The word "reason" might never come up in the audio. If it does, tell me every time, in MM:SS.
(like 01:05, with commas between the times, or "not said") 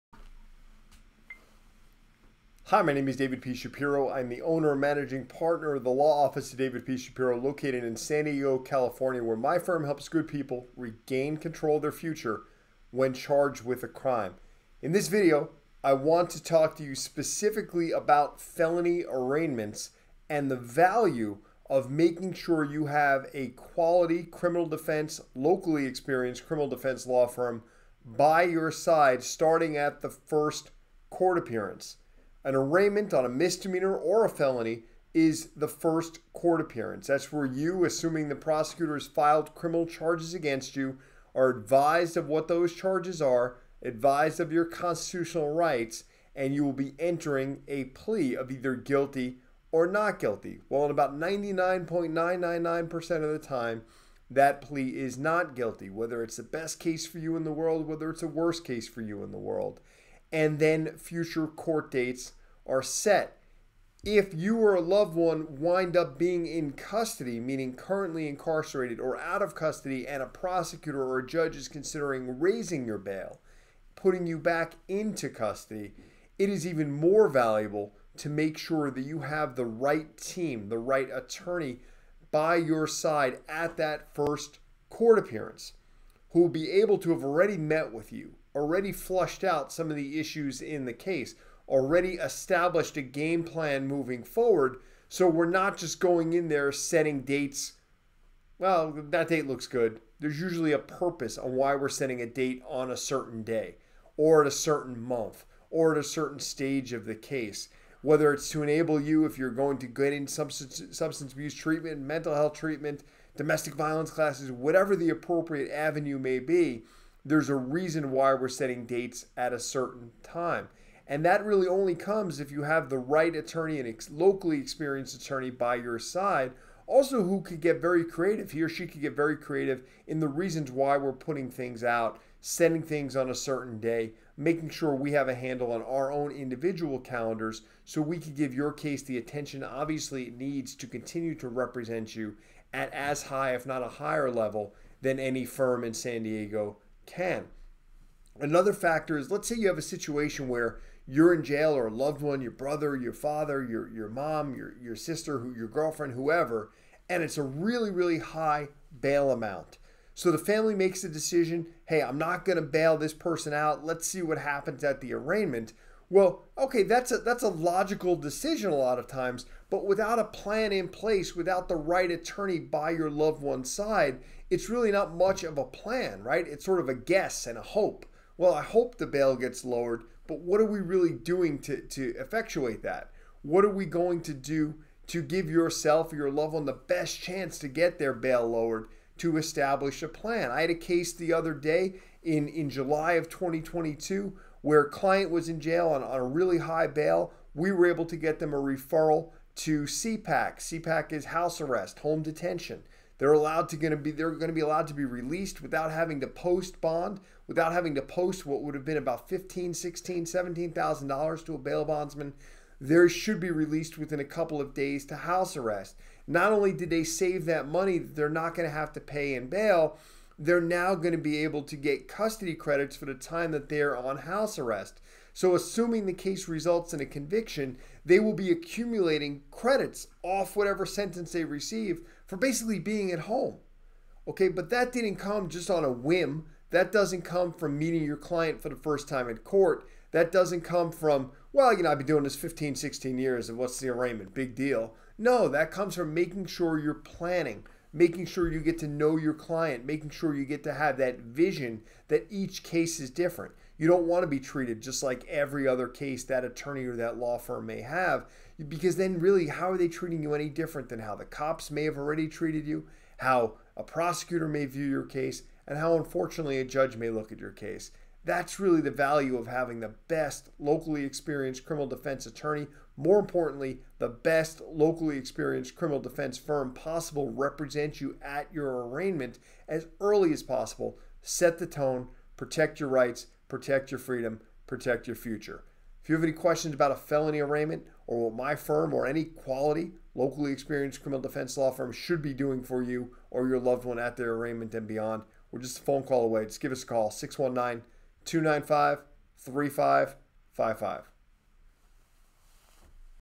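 01:57, 02:10.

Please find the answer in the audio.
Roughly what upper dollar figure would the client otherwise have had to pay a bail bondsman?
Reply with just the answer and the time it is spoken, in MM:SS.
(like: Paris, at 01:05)
17,000 dollars, at 03:30.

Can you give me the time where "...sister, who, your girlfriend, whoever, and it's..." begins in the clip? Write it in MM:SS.
02:34.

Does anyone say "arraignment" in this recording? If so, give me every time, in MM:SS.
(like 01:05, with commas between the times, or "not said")
00:19, 00:32, 02:45, 04:03, 04:38, 04:47, 04:54.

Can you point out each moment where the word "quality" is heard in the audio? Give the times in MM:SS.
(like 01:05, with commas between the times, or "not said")
00:23, 04:49.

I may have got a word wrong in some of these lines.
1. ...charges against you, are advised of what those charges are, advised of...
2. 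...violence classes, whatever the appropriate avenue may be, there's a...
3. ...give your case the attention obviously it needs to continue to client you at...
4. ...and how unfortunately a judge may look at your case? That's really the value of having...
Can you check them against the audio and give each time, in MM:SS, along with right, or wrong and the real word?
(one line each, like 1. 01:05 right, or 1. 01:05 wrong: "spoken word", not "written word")
1. 00:39 right
2. 01:53 right
3. 02:18 wrong: "represent", not "client"
4. 04:25 right.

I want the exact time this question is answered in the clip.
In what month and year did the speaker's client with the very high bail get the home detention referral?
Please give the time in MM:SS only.
03:12.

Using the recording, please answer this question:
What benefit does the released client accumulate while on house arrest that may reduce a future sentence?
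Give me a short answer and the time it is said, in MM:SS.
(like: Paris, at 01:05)
custody credits, at 03:42.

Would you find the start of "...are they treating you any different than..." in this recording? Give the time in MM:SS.
04:19.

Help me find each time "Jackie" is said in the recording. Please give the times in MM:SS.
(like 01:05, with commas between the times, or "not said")
not said.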